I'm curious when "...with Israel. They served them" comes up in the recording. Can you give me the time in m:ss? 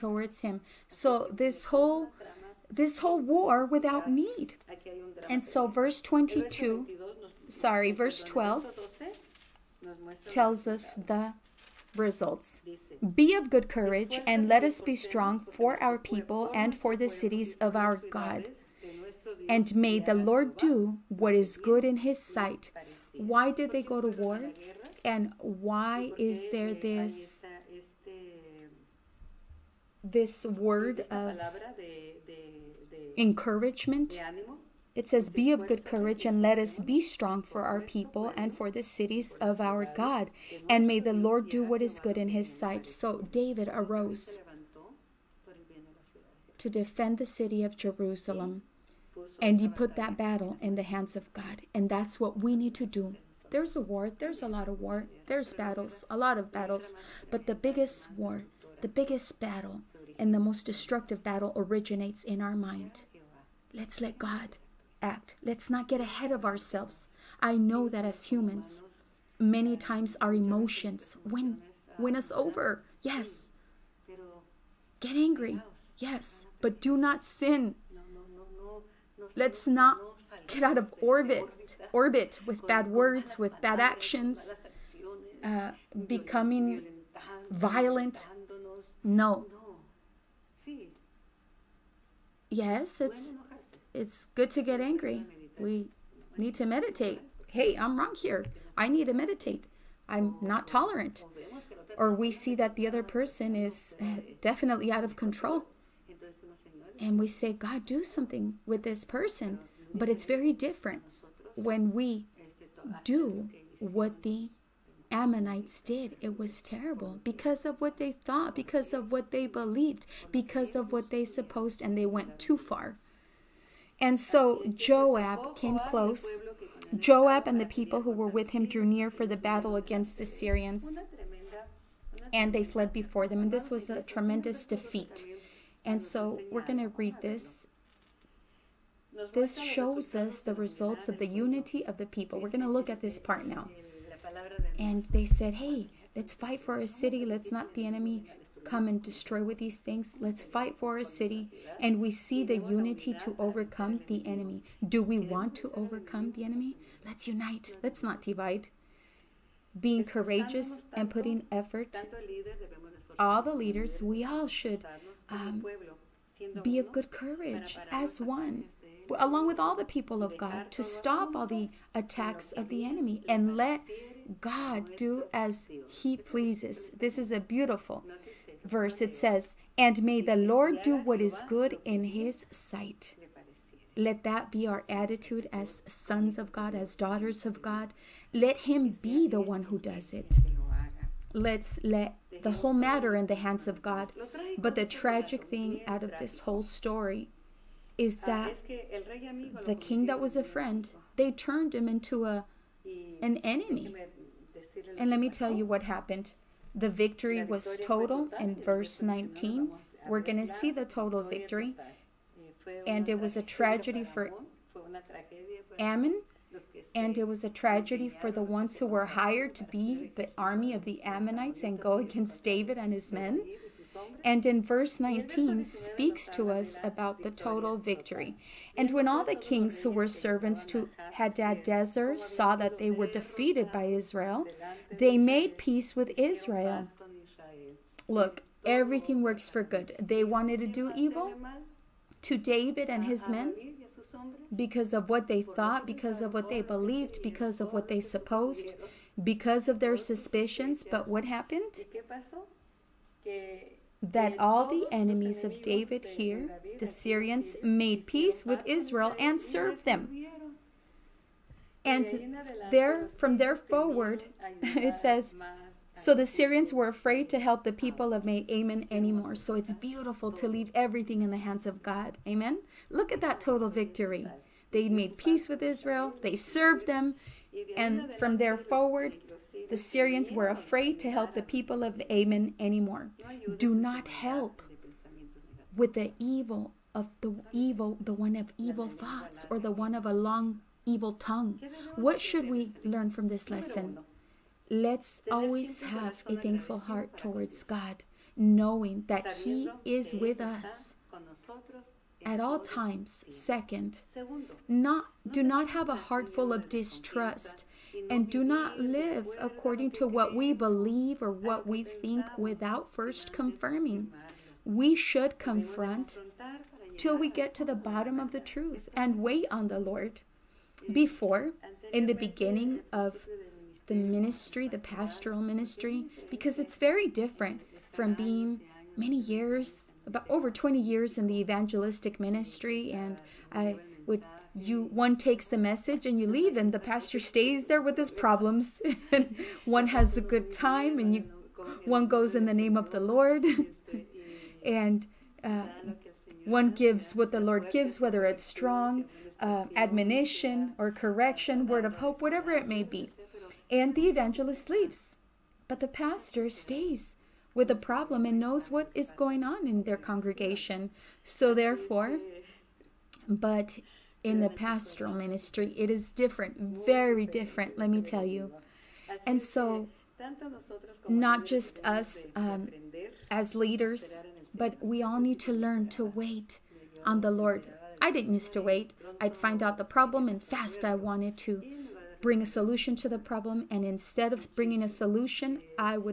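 4:35.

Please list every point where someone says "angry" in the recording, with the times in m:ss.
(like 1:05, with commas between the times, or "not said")
1:15, 1:34.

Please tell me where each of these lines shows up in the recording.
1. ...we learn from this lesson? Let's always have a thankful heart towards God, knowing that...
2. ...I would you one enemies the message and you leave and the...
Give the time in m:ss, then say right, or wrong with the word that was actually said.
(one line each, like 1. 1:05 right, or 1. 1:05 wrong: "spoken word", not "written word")
1. 4:52 right
2. 5:33 wrong: "takes", not "enemies".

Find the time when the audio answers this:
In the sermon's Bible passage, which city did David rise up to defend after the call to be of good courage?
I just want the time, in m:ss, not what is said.
0:47.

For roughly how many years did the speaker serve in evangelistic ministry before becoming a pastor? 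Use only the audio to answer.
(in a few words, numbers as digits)
Over 20 years.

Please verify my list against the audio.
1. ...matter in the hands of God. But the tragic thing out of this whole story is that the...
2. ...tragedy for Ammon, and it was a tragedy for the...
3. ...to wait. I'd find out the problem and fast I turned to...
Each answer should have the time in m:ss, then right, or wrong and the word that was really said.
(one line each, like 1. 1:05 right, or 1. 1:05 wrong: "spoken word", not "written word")
1. 3:12 right
2. 3:33 right
3. 6:18 wrong: "wanted", not "turned".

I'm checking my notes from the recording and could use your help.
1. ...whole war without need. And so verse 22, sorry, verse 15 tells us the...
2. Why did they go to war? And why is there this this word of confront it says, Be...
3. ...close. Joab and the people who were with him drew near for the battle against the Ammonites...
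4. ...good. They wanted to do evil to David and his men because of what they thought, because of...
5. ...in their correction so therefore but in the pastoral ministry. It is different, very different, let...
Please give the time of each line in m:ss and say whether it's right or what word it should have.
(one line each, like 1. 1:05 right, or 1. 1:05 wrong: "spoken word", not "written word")
1. 0:02 wrong: "12", not "15"
2. 0:23 wrong: "encouragement", not "confront"
3. 2:05 wrong: "Syrians", not "Ammonites"
4. 3:59 right
5. 5:59 wrong: "congregation", not "correction".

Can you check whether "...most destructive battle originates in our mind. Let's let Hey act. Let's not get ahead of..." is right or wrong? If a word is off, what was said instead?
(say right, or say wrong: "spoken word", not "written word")
wrong: "God", not "Hey".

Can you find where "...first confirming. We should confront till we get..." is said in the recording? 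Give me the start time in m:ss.
5:12.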